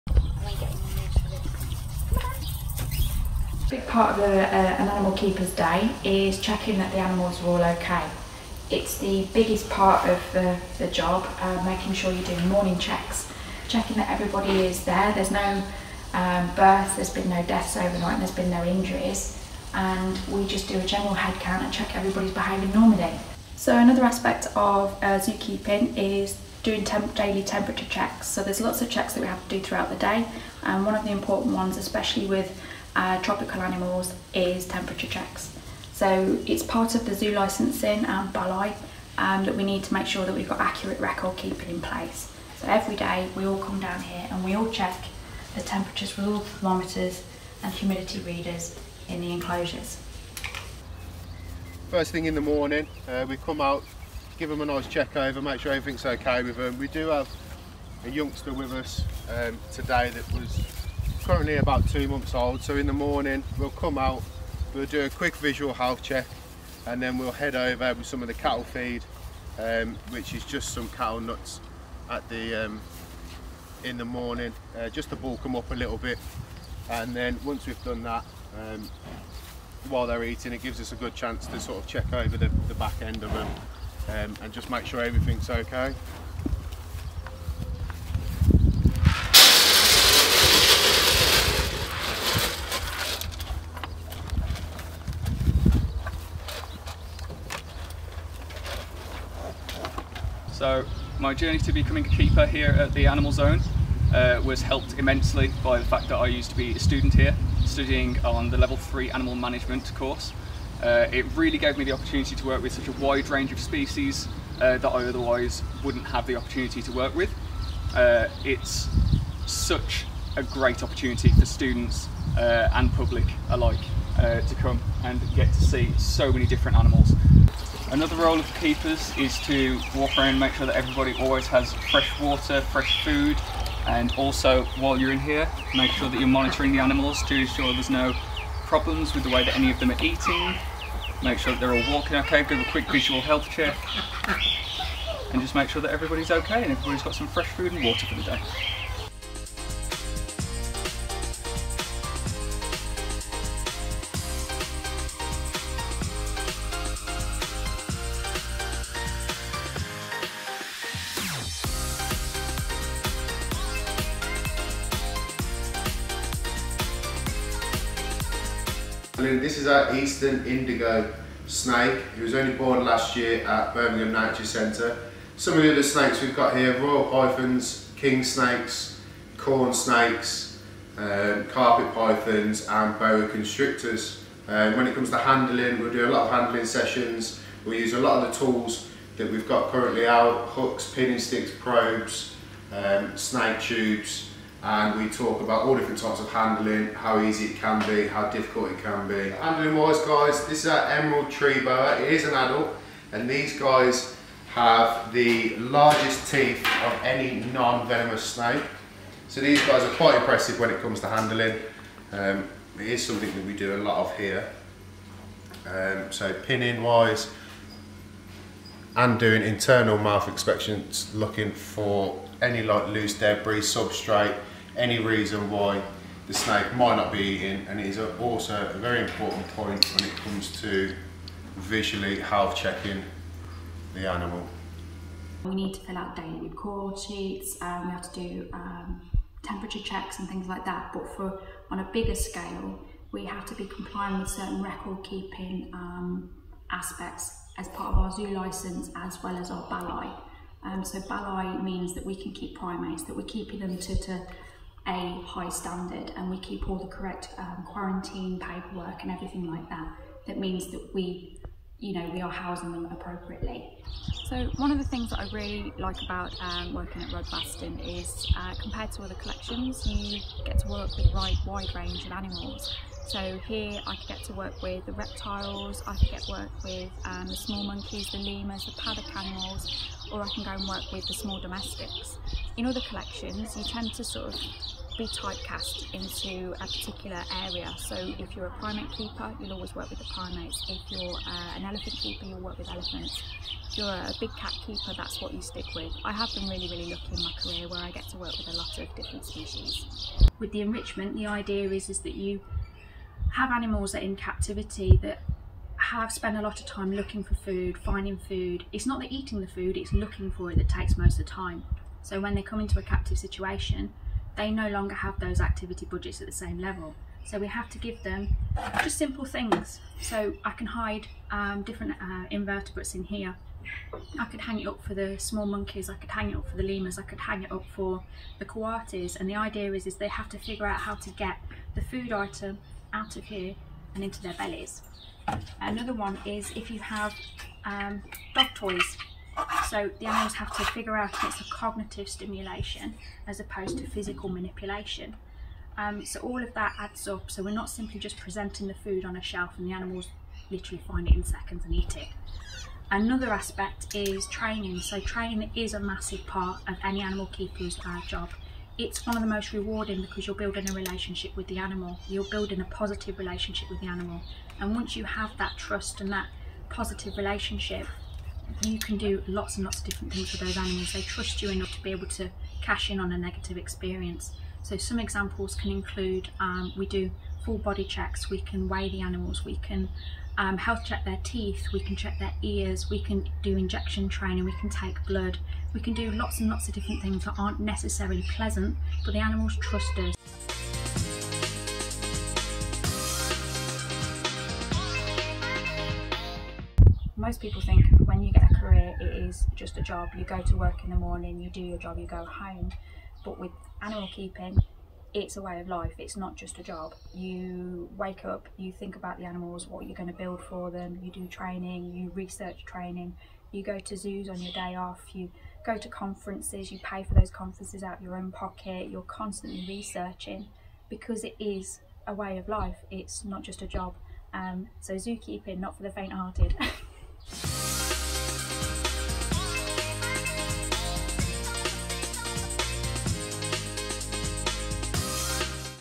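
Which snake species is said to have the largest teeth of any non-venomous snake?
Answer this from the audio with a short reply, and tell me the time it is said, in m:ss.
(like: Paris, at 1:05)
Emerald Tree Boa, at 3:20.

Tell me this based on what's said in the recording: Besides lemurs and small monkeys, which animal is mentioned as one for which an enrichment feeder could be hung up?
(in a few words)
Coatis.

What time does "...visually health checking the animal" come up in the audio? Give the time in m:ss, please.
3:51.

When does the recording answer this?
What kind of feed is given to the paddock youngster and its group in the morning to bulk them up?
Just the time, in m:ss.
1:10.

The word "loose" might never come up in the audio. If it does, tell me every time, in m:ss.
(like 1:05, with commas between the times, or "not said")
3:42.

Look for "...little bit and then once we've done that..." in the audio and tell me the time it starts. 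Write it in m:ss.
1:15.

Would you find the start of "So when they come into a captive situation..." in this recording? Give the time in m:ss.
5:12.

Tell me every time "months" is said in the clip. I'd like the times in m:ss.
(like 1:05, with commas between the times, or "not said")
1:02.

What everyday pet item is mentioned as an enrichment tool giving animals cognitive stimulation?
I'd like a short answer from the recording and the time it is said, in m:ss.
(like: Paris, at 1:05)
Dog toys, at 5:38.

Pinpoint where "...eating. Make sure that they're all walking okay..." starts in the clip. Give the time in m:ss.
2:20.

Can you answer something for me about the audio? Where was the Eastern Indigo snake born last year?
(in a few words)
Birmingham Nature Centre.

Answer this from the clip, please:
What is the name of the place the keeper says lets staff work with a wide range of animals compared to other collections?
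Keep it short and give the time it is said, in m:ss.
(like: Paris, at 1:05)
Rodbaston, at 4:27.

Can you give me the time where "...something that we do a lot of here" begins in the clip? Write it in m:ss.
3:33.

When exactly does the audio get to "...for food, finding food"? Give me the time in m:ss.
5:07.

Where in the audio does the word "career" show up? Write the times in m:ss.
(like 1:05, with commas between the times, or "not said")
4:57, 6:38.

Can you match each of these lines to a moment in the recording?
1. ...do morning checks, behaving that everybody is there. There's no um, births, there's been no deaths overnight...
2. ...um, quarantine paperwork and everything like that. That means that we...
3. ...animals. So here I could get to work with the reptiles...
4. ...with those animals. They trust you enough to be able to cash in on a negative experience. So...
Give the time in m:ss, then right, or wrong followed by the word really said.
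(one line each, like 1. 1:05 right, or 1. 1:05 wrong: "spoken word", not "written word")
1. 0:12 wrong: "checking", not "behaving"
2. 4:17 right
3. 4:32 right
4. 6:10 right.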